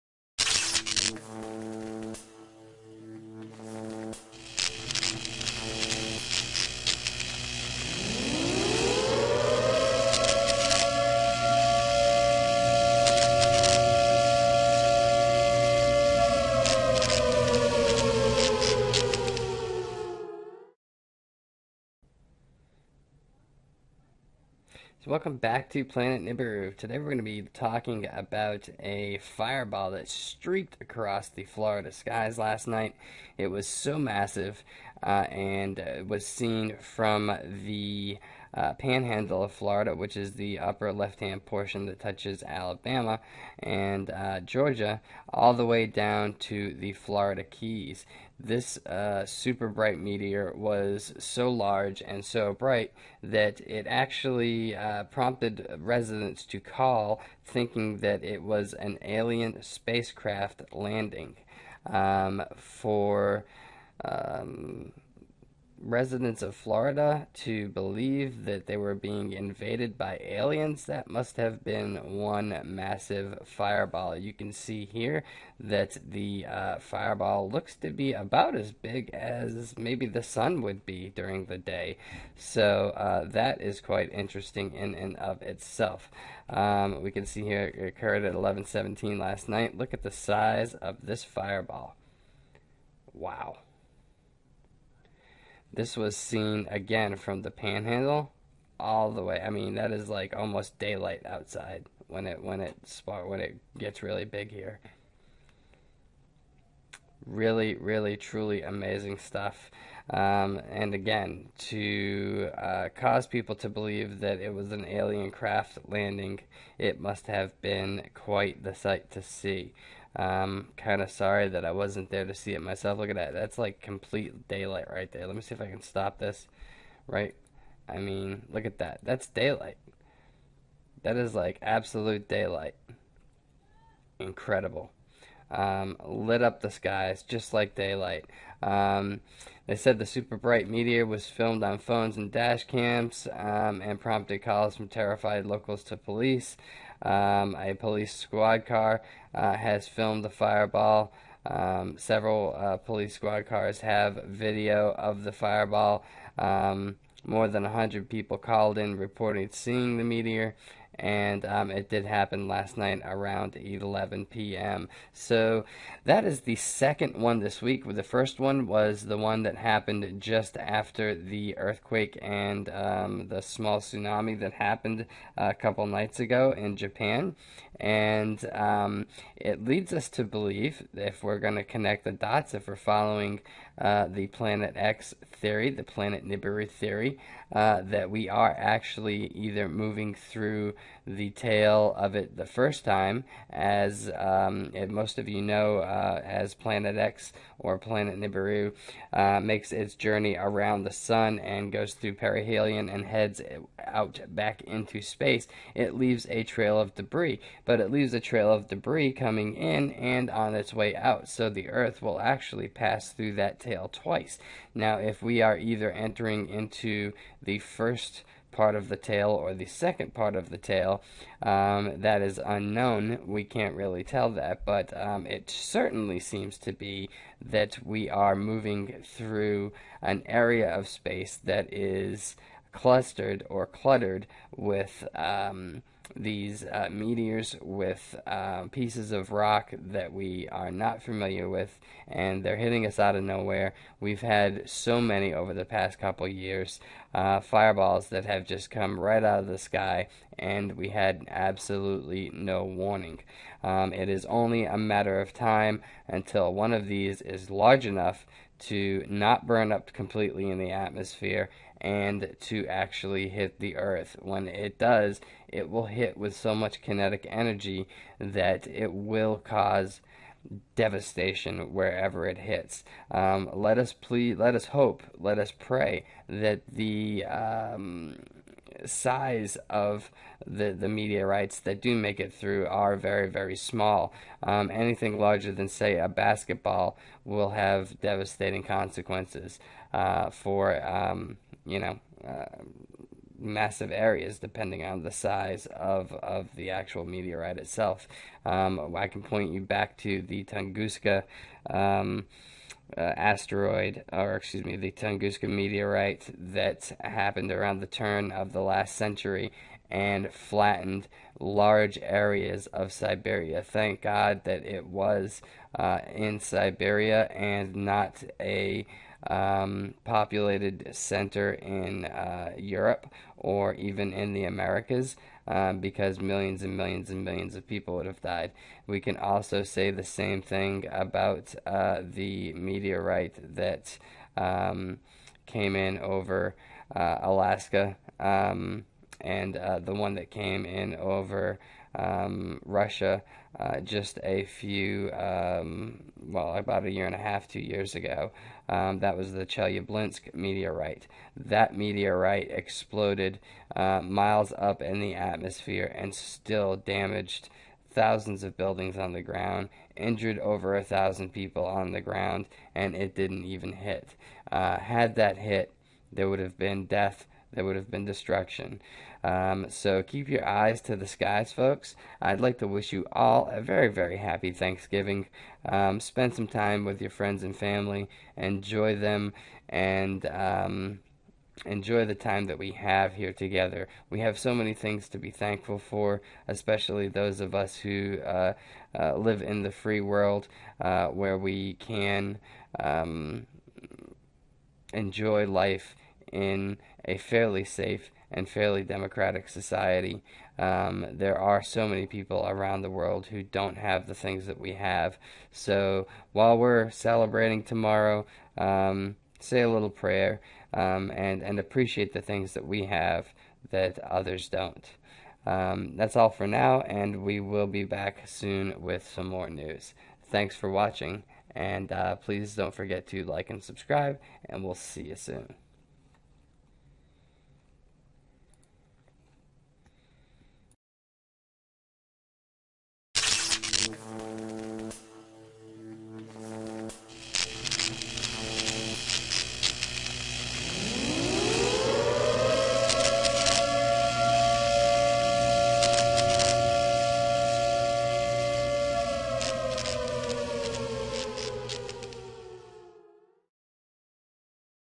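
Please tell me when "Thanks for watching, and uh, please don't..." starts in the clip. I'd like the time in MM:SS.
07:00.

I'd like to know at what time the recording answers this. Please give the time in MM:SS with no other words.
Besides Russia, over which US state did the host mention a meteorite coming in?
05:37.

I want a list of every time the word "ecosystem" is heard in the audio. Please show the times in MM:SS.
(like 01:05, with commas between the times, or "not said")
not said.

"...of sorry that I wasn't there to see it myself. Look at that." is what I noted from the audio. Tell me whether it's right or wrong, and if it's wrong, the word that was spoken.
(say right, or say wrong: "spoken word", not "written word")
right.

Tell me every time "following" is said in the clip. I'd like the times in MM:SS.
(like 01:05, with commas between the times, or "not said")
03:02.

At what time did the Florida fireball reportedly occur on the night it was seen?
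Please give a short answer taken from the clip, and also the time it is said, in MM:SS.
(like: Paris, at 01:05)
11:17, at 01:28.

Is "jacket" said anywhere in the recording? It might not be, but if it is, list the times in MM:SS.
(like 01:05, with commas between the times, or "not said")
not said.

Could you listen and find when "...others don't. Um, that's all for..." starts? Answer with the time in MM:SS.
06:53.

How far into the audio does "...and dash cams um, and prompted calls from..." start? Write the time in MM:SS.
02:22.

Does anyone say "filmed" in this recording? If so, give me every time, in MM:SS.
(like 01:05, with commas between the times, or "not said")
02:21, 02:29.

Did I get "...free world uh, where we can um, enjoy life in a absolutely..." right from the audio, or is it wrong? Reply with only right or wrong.
wrong.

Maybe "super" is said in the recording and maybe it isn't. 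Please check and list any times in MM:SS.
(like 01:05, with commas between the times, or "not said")
00:49, 02:20.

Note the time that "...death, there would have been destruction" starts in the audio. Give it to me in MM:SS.
06:06.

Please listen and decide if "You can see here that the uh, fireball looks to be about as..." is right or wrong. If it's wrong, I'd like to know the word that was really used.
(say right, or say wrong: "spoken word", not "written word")
right.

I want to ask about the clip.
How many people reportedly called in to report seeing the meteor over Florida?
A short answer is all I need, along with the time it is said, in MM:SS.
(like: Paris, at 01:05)
more than 100, at 02:37.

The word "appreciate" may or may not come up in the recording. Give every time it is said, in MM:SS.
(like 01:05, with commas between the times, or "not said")
06:51.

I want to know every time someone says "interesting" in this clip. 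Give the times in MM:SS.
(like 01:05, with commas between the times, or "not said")
01:24.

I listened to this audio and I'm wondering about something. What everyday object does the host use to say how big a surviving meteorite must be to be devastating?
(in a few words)
basketball.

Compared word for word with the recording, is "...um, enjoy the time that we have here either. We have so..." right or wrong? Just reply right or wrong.
wrong.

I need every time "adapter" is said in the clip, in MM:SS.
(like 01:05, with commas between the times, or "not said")
not said.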